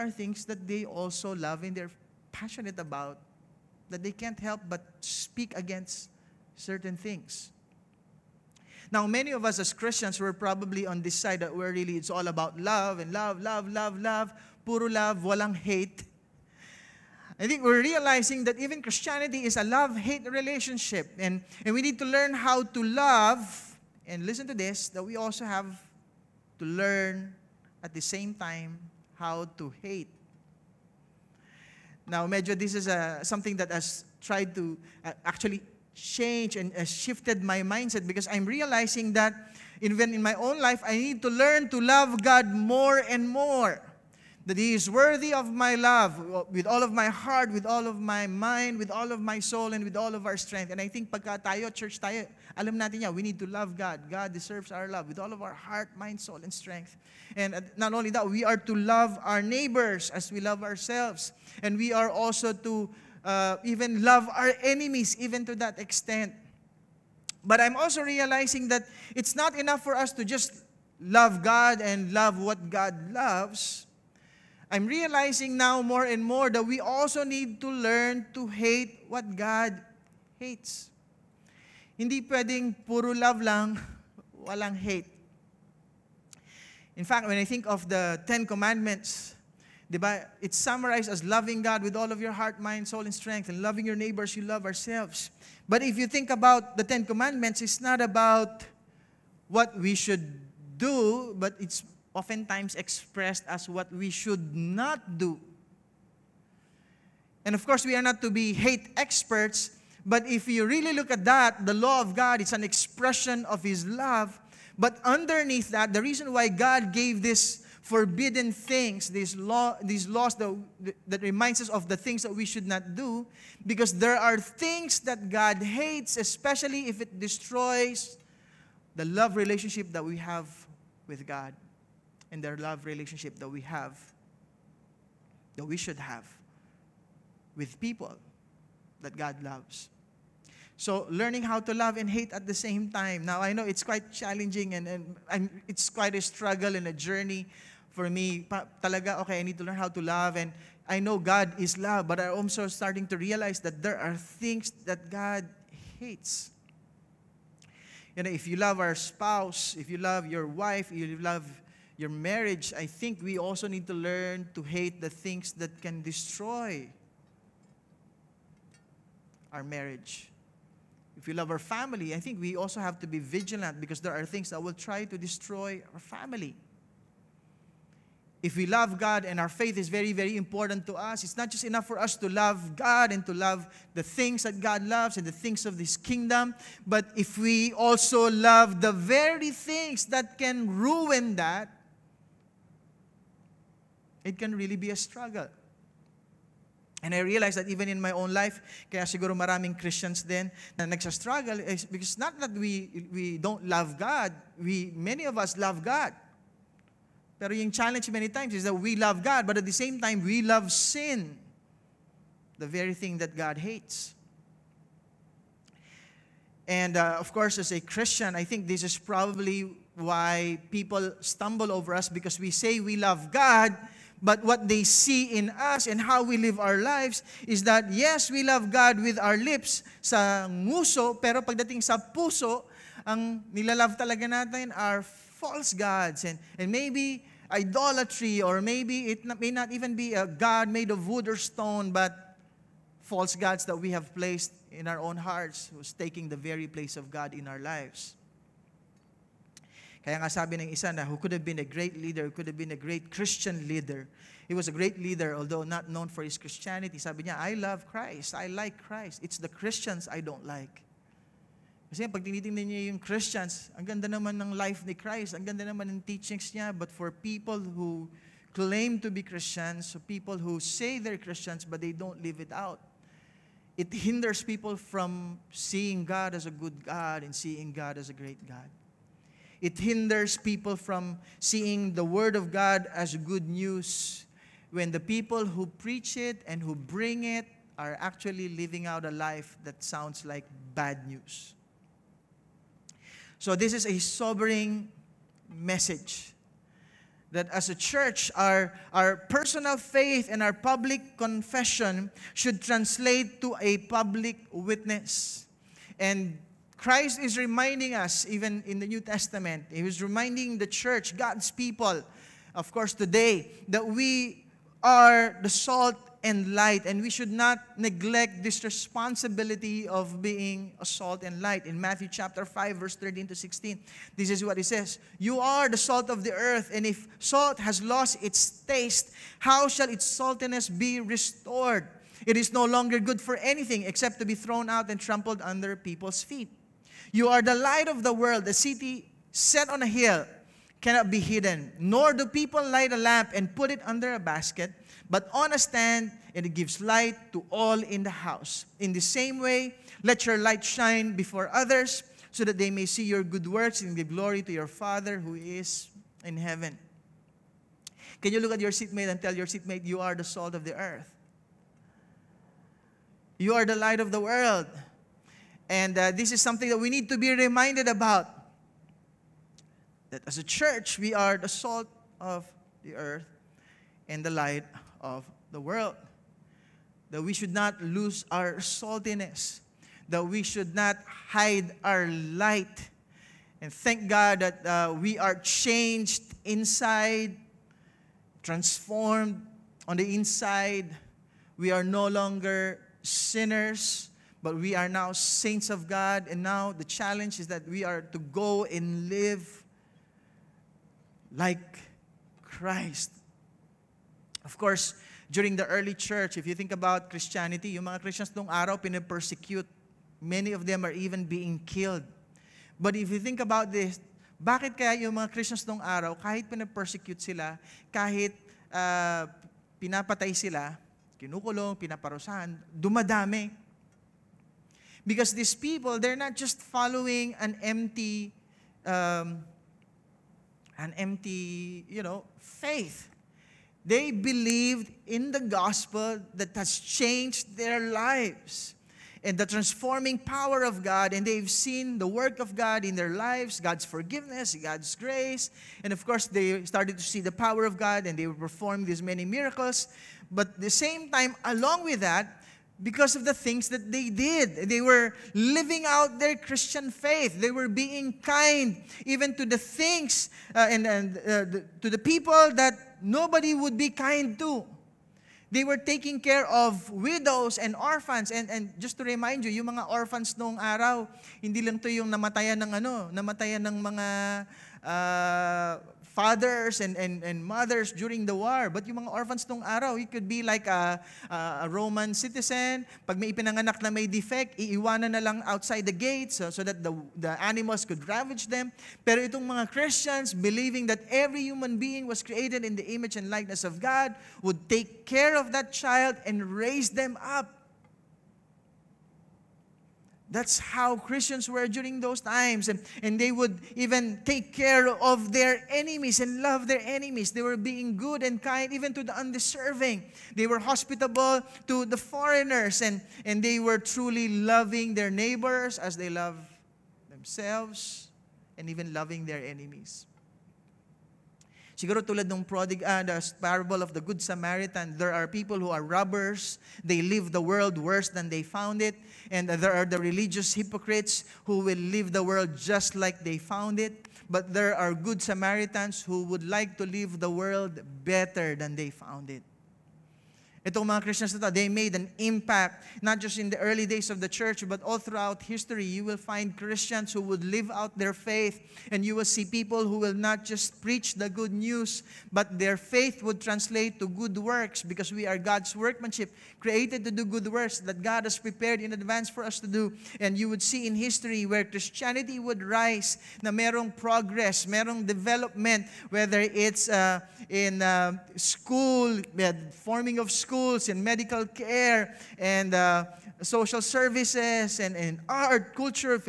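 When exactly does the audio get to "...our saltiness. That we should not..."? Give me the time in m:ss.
6:18.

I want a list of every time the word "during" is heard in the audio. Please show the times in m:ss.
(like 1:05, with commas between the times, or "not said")
6:45, 7:57, 8:21.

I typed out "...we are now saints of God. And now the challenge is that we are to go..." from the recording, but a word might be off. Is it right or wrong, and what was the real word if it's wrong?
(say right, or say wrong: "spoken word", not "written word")
right.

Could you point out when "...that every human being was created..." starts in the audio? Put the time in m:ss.
8:10.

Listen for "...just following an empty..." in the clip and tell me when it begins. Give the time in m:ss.
7:06.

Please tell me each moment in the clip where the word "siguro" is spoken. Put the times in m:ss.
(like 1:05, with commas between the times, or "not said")
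3:19, 8:41.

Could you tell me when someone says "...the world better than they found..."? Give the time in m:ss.
8:57.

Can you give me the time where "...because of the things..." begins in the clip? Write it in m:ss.
7:32.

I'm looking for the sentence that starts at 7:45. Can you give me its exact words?
They were taking care of widows and orphans.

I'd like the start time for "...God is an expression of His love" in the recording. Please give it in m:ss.
1:52.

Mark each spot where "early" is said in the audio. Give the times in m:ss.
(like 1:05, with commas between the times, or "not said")
6:45, 9:03.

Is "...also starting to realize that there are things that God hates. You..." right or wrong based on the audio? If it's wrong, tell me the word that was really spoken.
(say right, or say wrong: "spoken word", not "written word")
right.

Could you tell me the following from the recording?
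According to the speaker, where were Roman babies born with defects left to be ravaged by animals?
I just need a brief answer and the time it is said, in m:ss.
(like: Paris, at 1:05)
outside the gates, at 8:05.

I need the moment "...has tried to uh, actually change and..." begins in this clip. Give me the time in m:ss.
0:33.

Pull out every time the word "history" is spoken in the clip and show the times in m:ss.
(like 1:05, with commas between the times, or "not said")
9:05, 9:20.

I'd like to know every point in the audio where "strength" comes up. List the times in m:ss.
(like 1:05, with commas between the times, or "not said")
0:50, 0:56, 1:33.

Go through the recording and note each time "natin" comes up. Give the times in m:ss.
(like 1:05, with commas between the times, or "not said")
0:52, 3:54.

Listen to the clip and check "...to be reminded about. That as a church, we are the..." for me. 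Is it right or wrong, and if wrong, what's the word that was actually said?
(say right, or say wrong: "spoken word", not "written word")
right.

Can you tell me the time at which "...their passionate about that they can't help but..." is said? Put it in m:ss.
0:01.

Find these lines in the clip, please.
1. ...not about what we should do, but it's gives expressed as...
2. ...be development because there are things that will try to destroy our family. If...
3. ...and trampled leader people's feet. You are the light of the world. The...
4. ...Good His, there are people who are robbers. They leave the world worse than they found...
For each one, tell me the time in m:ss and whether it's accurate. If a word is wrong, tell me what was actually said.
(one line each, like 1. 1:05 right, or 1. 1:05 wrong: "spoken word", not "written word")
1. 1:37 wrong: "oftentimes", not "gives"
2. 2:53 wrong: "vigilant", not "development"
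3. 5:34 wrong: "under", not "leader"
4. 8:44 wrong: "Samaritan", not "His".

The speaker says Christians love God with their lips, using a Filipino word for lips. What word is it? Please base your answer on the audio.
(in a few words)
nguso.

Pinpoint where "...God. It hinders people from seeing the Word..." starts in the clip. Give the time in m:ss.
4:38.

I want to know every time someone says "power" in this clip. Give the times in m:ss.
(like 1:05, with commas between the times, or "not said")
7:20, 7:27.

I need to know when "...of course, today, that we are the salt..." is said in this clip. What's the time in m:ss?
5:12.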